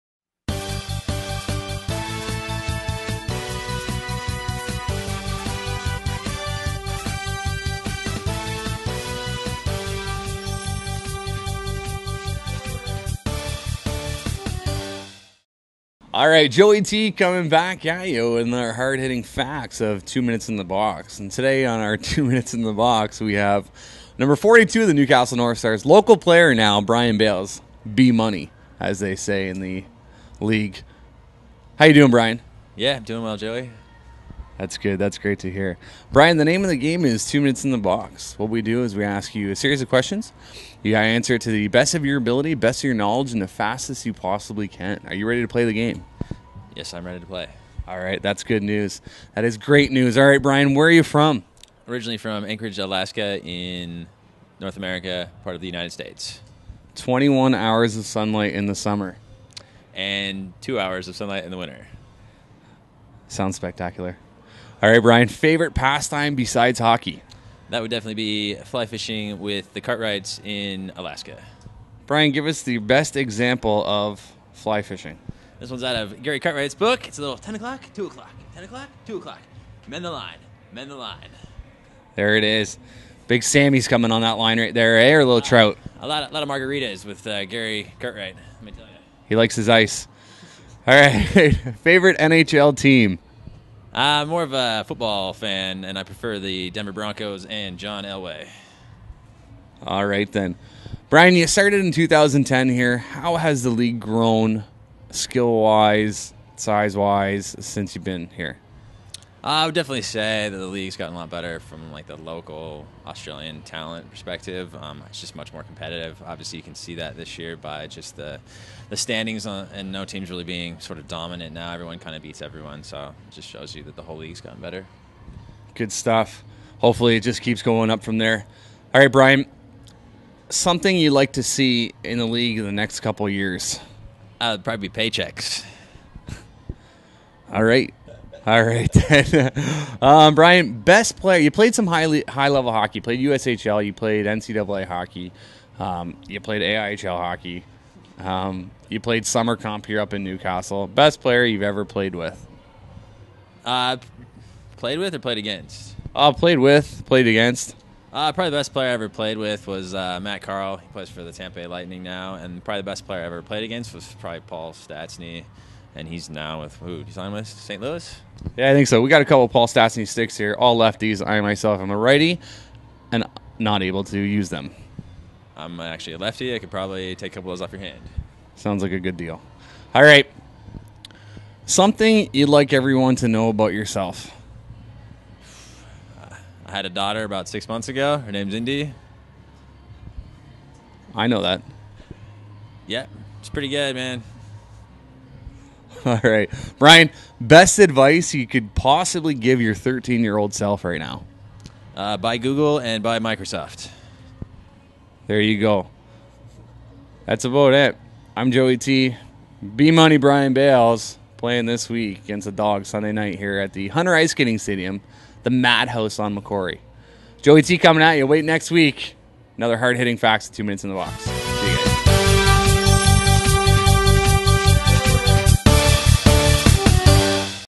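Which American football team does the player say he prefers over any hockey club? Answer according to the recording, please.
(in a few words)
Denver Broncos.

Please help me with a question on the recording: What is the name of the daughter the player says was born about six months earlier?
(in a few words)
Indy.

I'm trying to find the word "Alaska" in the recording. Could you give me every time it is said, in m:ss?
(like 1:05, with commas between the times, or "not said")
0:52, 1:10.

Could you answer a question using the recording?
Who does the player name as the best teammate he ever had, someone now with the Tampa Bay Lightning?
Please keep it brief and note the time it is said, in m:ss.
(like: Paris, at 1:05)
Matt Carle, at 2:40.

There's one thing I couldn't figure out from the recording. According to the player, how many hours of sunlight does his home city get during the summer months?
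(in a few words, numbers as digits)
21.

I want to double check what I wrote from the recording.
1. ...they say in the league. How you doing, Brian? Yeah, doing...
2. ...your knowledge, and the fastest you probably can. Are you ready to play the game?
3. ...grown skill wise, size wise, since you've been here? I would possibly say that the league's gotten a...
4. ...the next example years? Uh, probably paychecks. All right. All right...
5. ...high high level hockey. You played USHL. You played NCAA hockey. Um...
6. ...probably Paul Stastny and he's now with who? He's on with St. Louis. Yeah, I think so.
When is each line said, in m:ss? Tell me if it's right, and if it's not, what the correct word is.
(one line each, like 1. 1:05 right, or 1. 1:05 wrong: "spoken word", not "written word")
1. 0:28 right
2. 0:42 wrong: "possibly", not "probably"
3. 1:43 wrong: "definitely", not "possibly"
4. 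2:12 wrong: "couple", not "example"
5. 2:21 right
6. 2:44 right.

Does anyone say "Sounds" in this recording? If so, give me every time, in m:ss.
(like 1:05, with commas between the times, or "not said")
1:03, 2:58.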